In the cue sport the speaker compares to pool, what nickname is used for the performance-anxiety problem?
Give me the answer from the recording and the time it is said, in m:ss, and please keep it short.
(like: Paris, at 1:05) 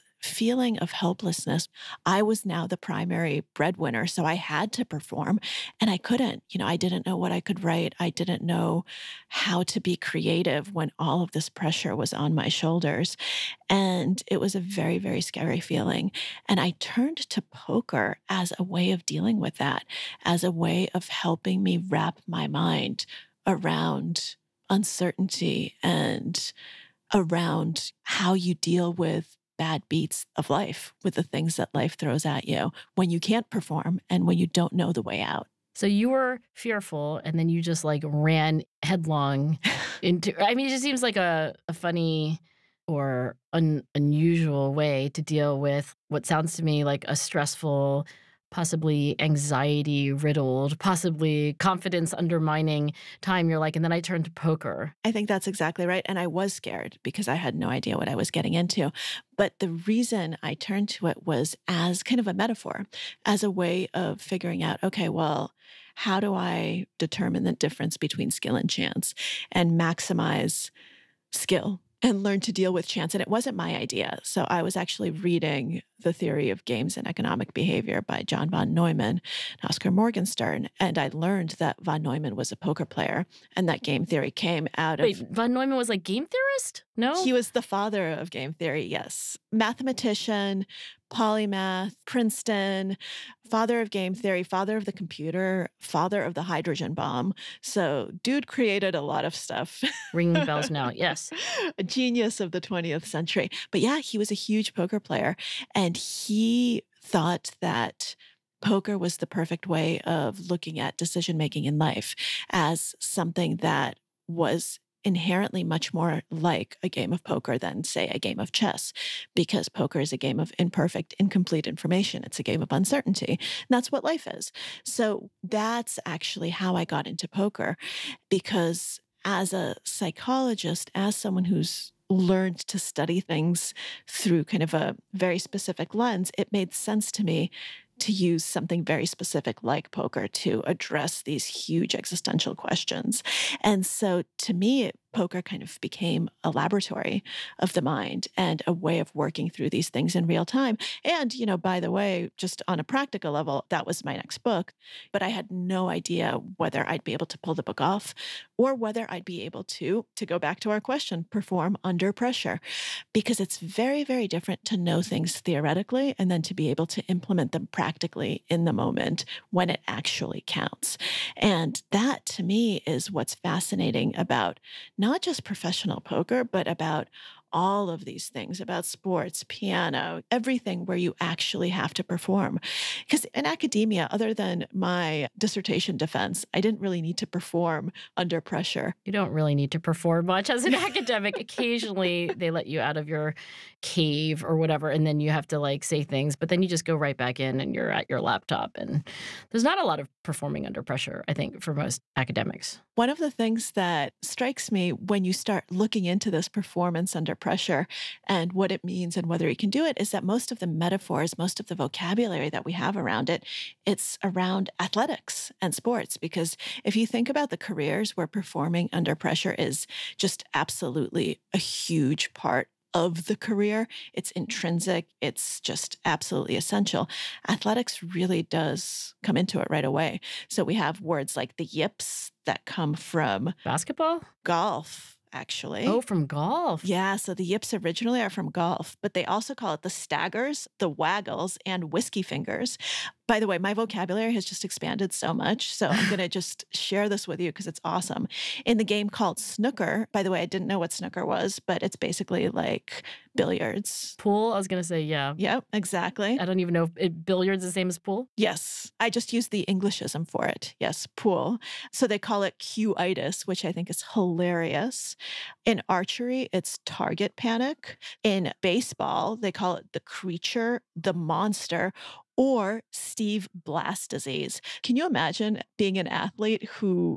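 Q-itis, at 4:22.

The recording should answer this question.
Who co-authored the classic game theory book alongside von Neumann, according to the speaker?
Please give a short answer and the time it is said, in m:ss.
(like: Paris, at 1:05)
Oscar Morgenstern, at 1:19.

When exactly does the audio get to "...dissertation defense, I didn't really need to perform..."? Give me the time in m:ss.
3:05.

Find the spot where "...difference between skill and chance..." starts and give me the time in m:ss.
1:07.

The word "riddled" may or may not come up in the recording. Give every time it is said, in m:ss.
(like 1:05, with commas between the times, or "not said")
0:50.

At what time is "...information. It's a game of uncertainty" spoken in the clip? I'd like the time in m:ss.
2:01.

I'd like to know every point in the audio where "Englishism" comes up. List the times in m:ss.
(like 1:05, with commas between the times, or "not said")
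4:19.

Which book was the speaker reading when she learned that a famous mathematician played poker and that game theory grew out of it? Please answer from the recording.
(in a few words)
The Theory of Games and Economic Behavior.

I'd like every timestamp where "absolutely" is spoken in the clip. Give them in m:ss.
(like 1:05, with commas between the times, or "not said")
3:40, 3:46.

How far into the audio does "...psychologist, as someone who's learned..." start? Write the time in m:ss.
2:09.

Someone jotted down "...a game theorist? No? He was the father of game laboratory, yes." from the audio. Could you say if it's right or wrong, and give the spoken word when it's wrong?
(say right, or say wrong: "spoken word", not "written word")
wrong: "theory", not "laboratory".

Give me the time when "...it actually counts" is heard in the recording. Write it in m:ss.
2:49.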